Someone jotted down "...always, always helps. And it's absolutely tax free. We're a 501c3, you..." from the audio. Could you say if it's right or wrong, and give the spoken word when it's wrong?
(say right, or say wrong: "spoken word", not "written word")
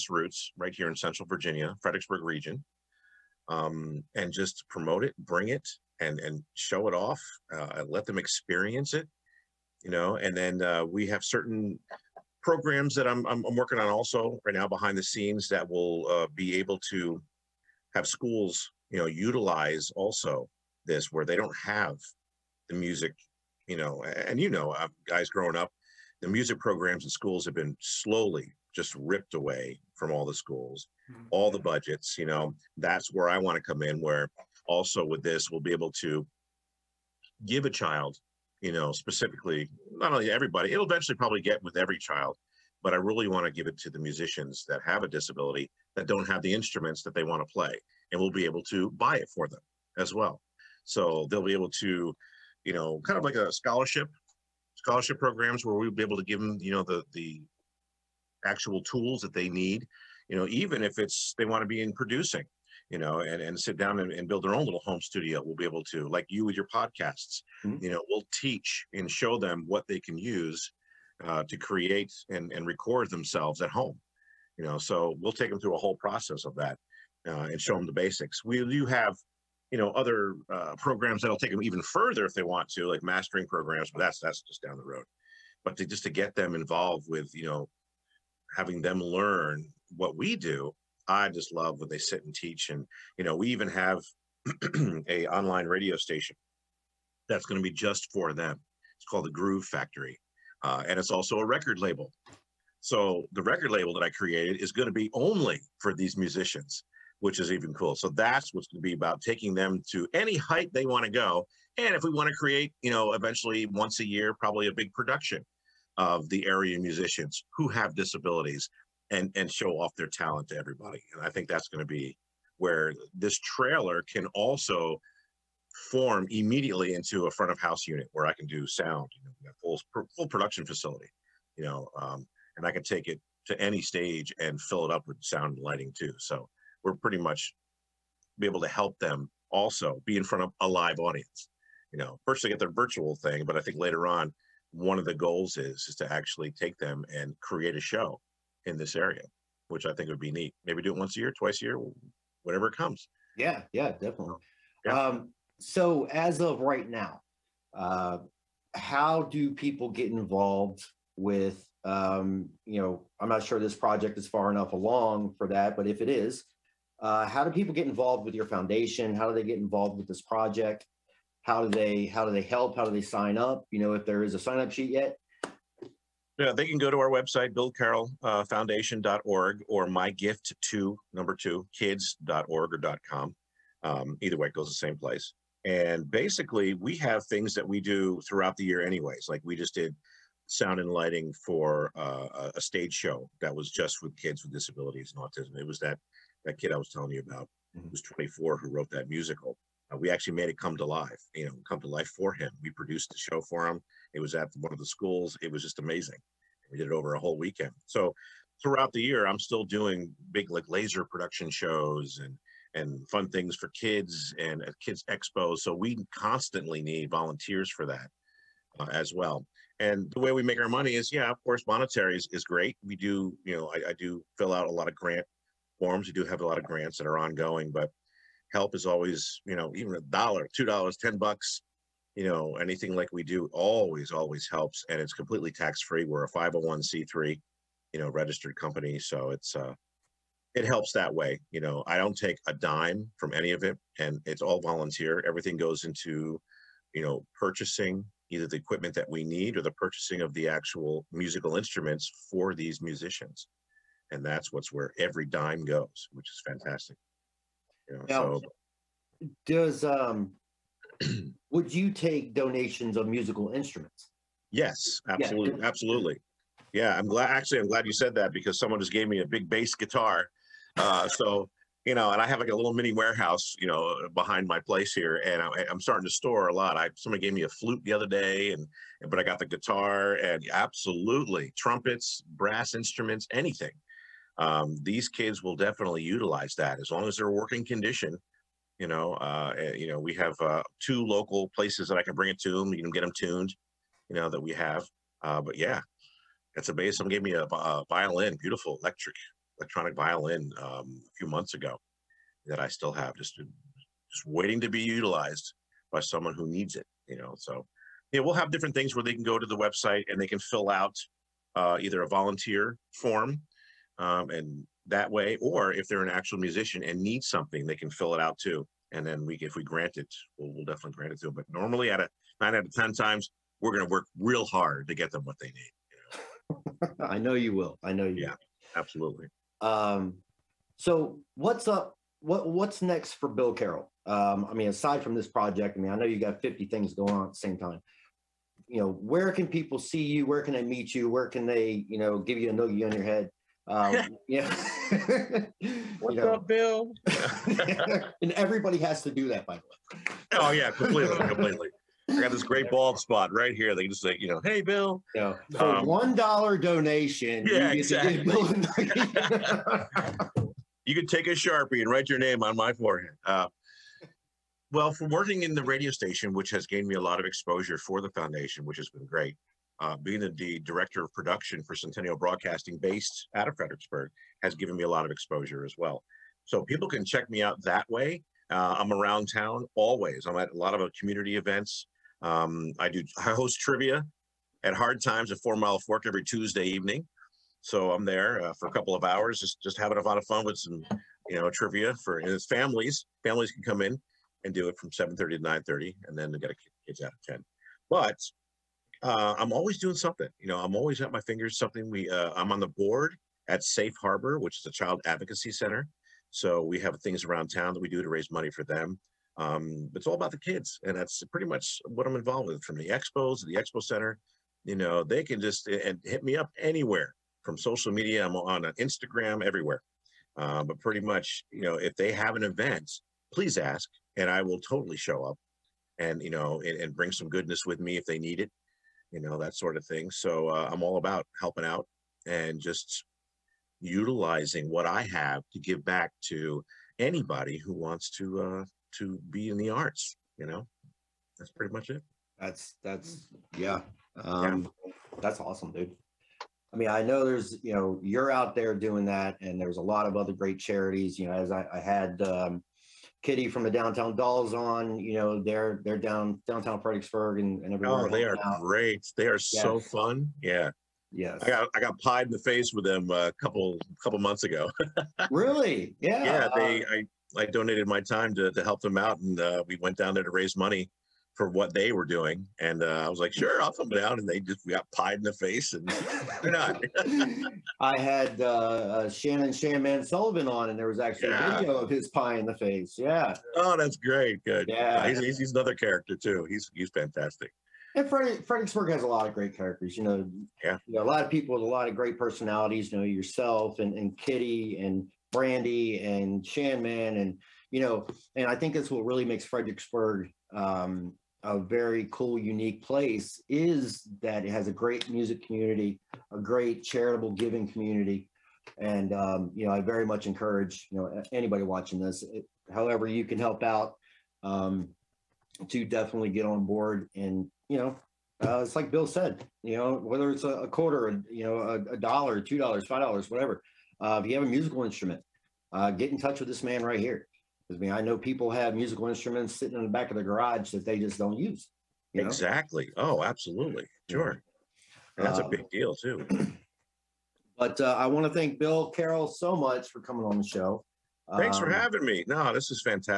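wrong: "completely", not "absolutely".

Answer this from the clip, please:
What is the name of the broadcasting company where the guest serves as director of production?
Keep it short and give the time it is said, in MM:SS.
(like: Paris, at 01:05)
Centennial Broadcasting, at 06:11.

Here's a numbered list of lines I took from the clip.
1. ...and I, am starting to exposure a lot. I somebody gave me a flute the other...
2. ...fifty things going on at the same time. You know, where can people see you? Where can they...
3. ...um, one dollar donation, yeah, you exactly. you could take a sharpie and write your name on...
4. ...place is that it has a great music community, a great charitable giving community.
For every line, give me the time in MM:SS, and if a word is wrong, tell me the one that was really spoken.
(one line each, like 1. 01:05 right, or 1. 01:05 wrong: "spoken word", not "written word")
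1. 04:35 wrong: "store", not "exposure"
2. 05:36 right
3. 05:55 right
4. 08:22 right.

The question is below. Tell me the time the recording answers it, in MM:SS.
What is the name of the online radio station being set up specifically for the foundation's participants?
01:39.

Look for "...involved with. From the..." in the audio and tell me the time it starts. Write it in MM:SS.
06:52.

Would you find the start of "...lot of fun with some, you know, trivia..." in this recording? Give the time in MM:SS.
06:30.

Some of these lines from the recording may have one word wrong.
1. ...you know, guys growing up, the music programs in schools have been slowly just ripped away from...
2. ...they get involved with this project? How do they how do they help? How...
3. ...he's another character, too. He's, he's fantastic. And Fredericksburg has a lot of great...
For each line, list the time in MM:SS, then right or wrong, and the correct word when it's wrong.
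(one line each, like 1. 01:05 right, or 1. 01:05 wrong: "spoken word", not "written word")
1. 00:24 right
2. 02:49 right
3. 08:05 right.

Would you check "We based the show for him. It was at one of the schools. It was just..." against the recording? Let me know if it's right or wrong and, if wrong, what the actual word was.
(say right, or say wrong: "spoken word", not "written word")
wrong: "produced", not "based".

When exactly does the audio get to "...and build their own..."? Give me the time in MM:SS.
01:04.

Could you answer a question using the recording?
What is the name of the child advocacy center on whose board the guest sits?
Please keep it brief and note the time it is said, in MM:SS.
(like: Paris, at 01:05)
Safe Harbor, at 06:43.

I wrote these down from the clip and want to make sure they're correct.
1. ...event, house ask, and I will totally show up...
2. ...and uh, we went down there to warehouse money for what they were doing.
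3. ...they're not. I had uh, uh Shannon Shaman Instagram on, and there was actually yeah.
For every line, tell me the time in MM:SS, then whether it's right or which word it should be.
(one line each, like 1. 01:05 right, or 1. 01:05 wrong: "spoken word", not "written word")
1. 07:02 wrong: "please", not "house"
2. 07:49 wrong: "raise", not "warehouse"
3. 07:56 wrong: "Sullivan", not "Instagram".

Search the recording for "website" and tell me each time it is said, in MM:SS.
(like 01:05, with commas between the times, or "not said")
02:57, 05:09.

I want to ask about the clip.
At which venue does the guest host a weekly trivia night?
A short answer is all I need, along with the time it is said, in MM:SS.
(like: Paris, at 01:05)
Hard Times, at 06:24.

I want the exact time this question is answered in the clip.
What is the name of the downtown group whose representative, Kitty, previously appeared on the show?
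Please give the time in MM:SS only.
07:33.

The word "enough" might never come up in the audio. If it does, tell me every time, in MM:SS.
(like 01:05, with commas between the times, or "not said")
02:44.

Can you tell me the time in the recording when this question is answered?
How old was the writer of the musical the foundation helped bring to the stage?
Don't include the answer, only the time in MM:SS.
03:18.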